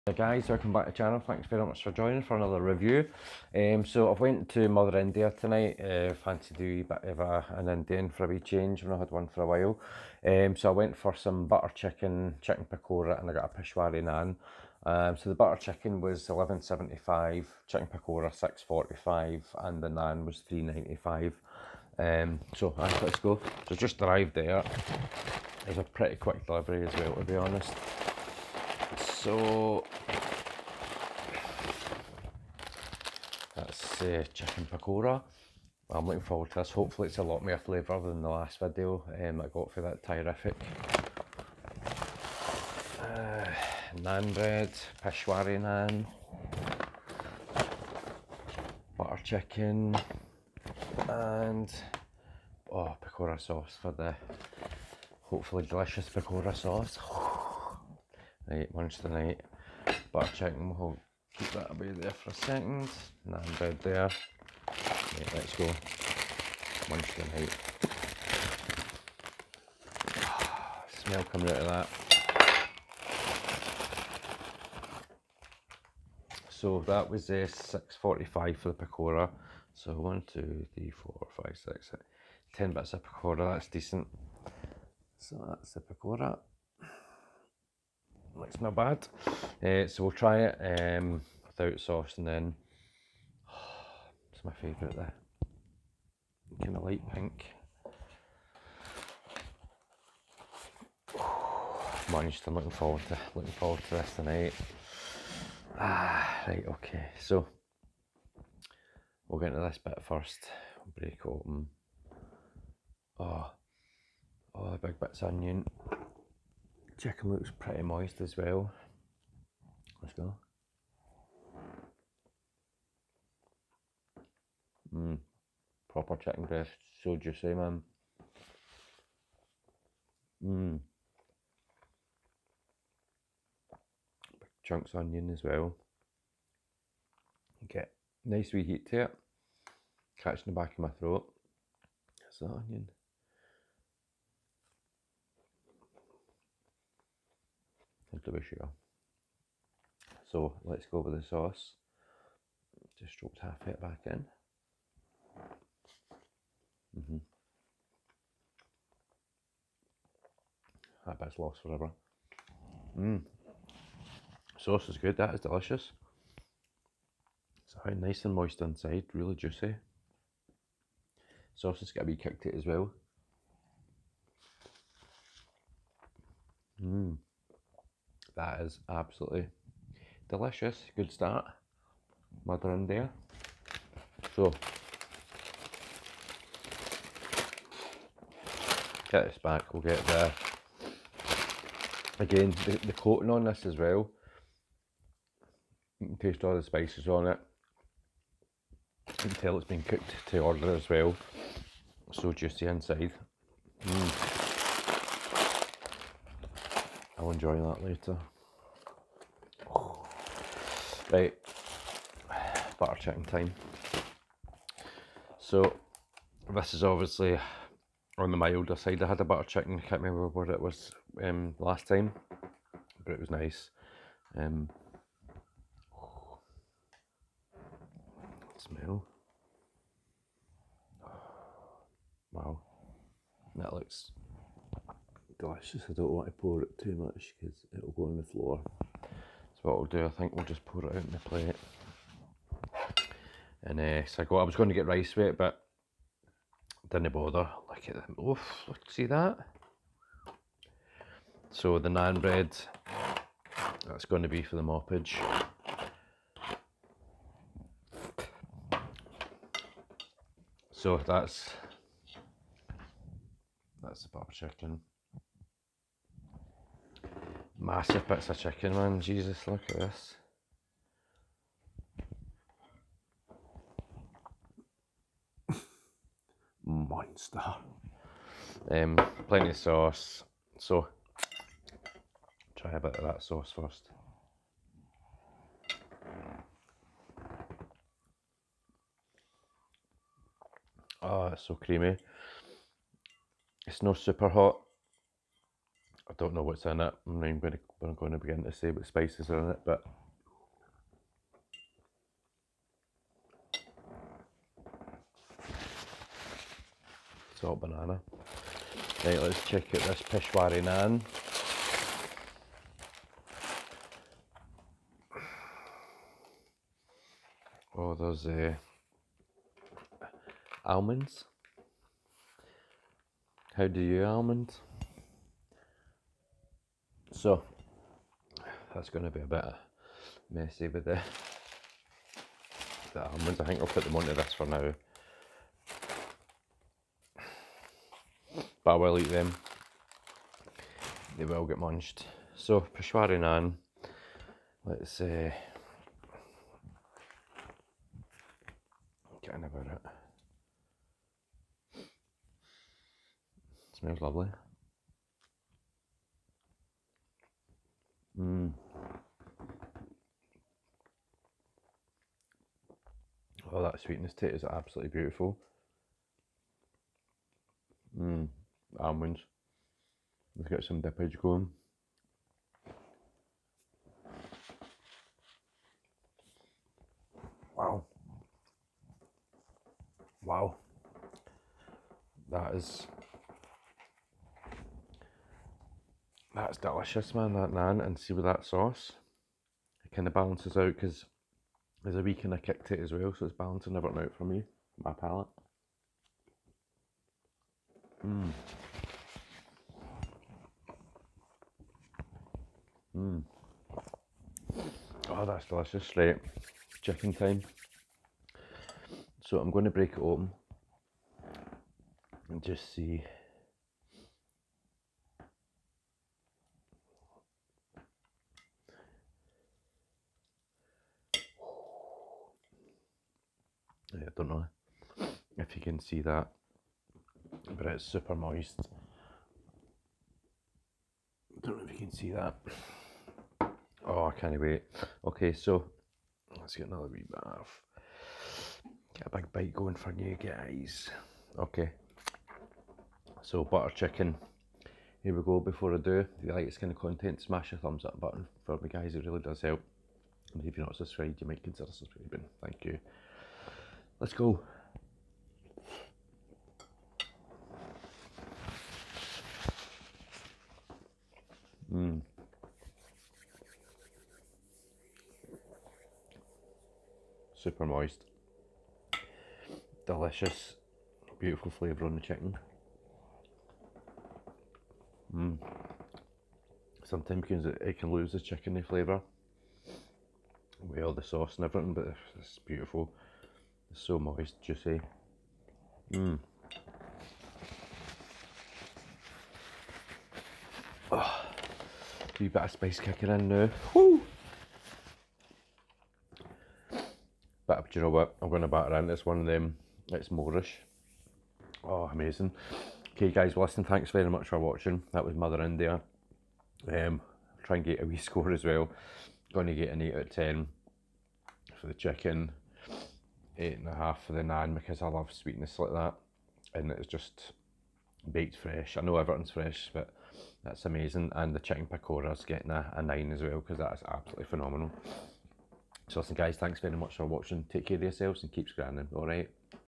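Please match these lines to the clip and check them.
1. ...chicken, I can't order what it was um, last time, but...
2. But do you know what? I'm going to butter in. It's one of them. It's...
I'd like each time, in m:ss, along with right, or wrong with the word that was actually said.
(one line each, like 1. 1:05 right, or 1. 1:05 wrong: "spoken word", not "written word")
1. 3:39 wrong: "remember", not "order"
2. 8:17 wrong: "batter", not "butter".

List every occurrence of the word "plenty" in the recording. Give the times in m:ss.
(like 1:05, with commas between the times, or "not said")
4:39.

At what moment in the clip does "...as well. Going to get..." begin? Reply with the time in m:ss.
8:28.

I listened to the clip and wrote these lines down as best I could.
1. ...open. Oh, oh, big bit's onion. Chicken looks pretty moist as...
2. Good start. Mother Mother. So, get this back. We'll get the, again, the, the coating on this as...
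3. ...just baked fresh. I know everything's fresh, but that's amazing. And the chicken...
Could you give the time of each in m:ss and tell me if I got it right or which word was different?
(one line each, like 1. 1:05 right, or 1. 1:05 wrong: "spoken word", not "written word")
1. 1:51 right
2. 3:00 wrong: "India", not "Mother"
3. 8:36 right.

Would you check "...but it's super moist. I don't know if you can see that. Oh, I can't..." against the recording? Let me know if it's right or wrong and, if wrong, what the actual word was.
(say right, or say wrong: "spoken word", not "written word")
right.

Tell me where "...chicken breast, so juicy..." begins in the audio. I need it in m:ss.
2:06.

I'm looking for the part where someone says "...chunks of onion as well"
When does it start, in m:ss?
2:14.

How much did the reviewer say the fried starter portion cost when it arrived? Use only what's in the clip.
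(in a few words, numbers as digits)
6.45.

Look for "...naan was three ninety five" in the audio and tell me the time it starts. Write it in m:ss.
0:19.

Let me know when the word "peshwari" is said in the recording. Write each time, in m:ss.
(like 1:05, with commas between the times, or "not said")
0:13, 0:45, 5:10, 5:42.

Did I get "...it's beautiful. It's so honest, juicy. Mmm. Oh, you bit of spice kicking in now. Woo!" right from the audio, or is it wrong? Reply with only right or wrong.
wrong.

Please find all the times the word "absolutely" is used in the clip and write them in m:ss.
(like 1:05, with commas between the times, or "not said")
2:58, 6:04, 8:43.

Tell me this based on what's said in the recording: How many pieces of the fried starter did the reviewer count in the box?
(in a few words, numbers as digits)
10.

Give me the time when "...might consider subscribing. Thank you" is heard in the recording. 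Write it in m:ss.
7:31.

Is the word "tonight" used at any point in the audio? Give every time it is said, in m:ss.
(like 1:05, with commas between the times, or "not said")
0:05, 0:59, 1:07, 1:44.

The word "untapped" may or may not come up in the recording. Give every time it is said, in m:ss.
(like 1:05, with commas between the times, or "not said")
not said.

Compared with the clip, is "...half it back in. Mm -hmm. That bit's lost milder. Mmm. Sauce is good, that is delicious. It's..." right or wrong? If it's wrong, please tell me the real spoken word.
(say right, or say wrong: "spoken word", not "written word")
wrong: "forever", not "milder".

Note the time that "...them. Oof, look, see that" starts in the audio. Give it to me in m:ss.
4:07.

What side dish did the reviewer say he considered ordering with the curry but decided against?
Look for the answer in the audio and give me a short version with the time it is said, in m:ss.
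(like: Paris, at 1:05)
rice, at 4:04.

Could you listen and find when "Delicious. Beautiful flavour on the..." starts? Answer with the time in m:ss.
7:49.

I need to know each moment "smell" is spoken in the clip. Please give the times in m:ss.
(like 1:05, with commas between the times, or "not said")
1:10, 3:48, 5:53.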